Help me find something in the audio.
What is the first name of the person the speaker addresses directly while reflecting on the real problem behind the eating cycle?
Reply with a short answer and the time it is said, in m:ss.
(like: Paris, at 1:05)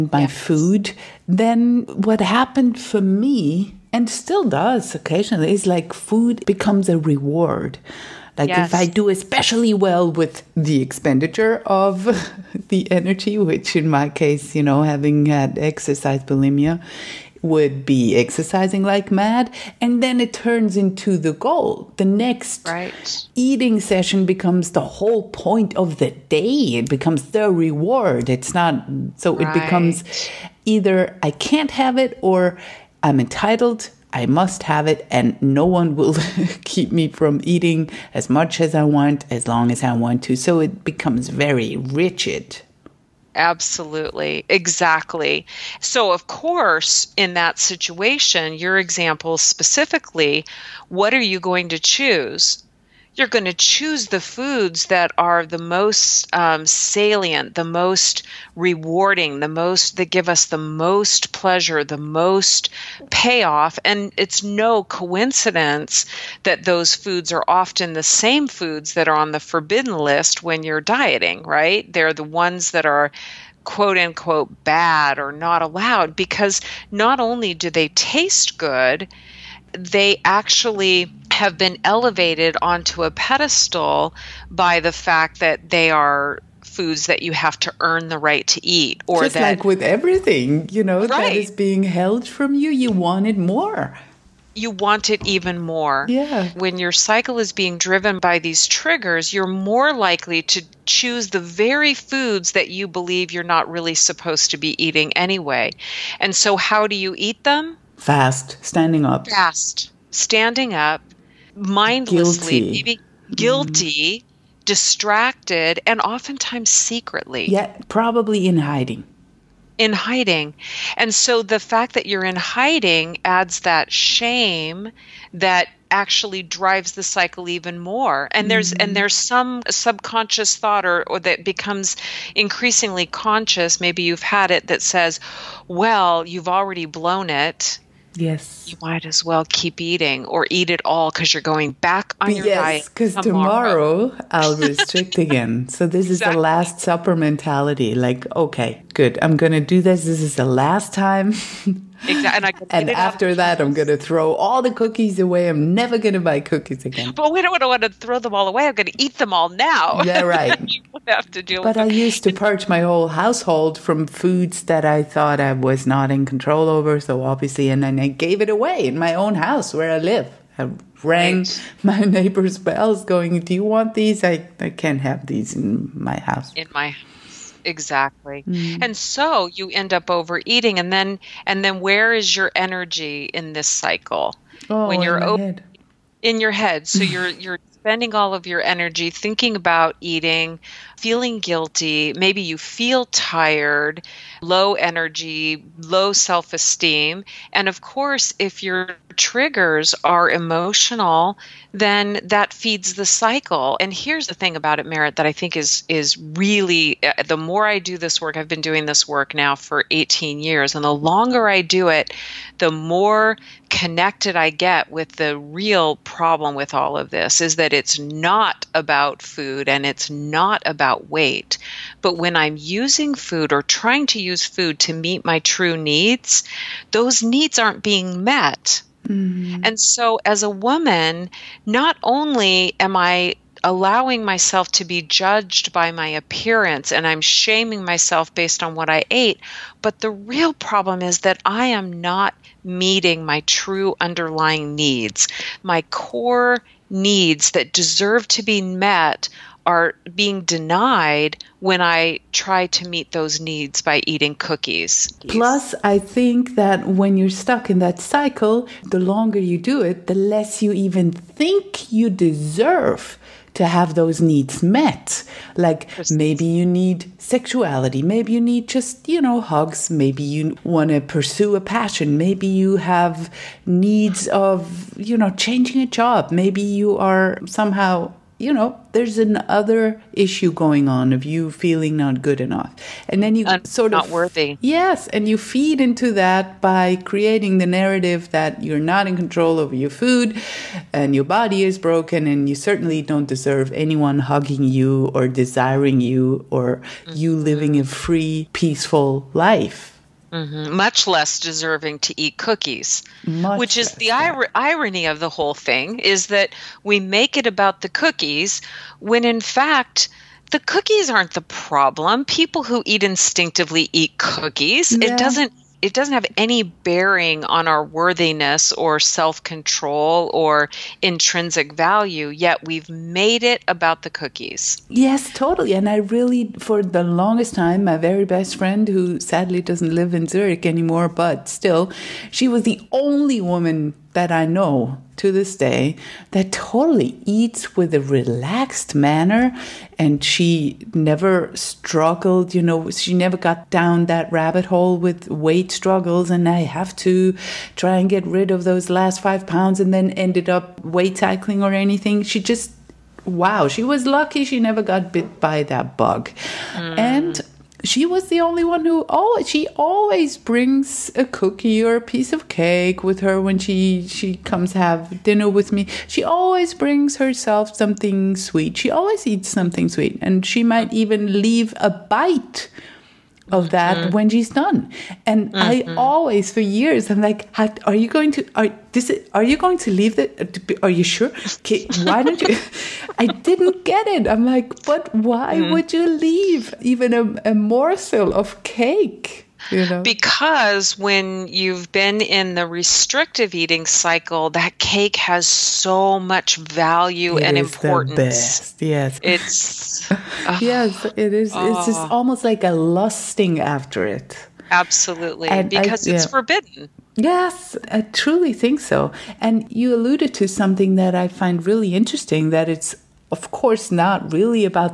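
Meret, at 3:24.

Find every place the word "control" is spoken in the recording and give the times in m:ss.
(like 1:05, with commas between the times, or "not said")
2:46, 4:49, 5:18.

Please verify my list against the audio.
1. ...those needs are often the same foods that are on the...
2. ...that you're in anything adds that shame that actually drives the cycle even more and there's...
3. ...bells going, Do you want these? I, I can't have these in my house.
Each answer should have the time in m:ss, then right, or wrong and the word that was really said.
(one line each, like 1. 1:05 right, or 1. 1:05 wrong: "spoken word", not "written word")
1. 1:06 wrong: "foods", not "needs"
2. 2:01 wrong: "hiding", not "anything"
3. 2:52 right.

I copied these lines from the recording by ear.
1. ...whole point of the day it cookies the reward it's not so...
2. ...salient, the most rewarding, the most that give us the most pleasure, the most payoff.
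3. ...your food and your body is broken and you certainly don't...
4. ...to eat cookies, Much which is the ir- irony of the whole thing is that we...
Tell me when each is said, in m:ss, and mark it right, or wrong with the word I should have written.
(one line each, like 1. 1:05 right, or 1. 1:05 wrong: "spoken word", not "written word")
1. 0:24 wrong: "becomes", not "cookies"
2. 0:56 right
3. 4:49 right
4. 5:02 right.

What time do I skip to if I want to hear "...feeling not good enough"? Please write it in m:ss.
4:41.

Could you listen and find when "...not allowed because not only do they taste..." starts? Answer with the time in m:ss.
1:15.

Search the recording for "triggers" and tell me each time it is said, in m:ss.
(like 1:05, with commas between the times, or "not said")
1:38, 3:19.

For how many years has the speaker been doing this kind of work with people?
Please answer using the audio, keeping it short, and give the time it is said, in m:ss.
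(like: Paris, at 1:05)
18 years, at 3:29.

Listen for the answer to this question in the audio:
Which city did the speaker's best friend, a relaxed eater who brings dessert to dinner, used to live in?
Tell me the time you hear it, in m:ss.
5:30.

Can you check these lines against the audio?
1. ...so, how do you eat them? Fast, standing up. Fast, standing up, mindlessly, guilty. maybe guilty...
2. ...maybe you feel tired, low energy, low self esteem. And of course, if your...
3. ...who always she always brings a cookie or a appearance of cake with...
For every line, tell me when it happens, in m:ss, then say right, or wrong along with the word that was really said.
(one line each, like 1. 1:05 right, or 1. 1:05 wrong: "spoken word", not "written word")
1. 1:46 right
2. 3:12 right
3. 5:58 wrong: "piece", not "appearance".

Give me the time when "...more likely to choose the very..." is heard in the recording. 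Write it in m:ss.
1:39.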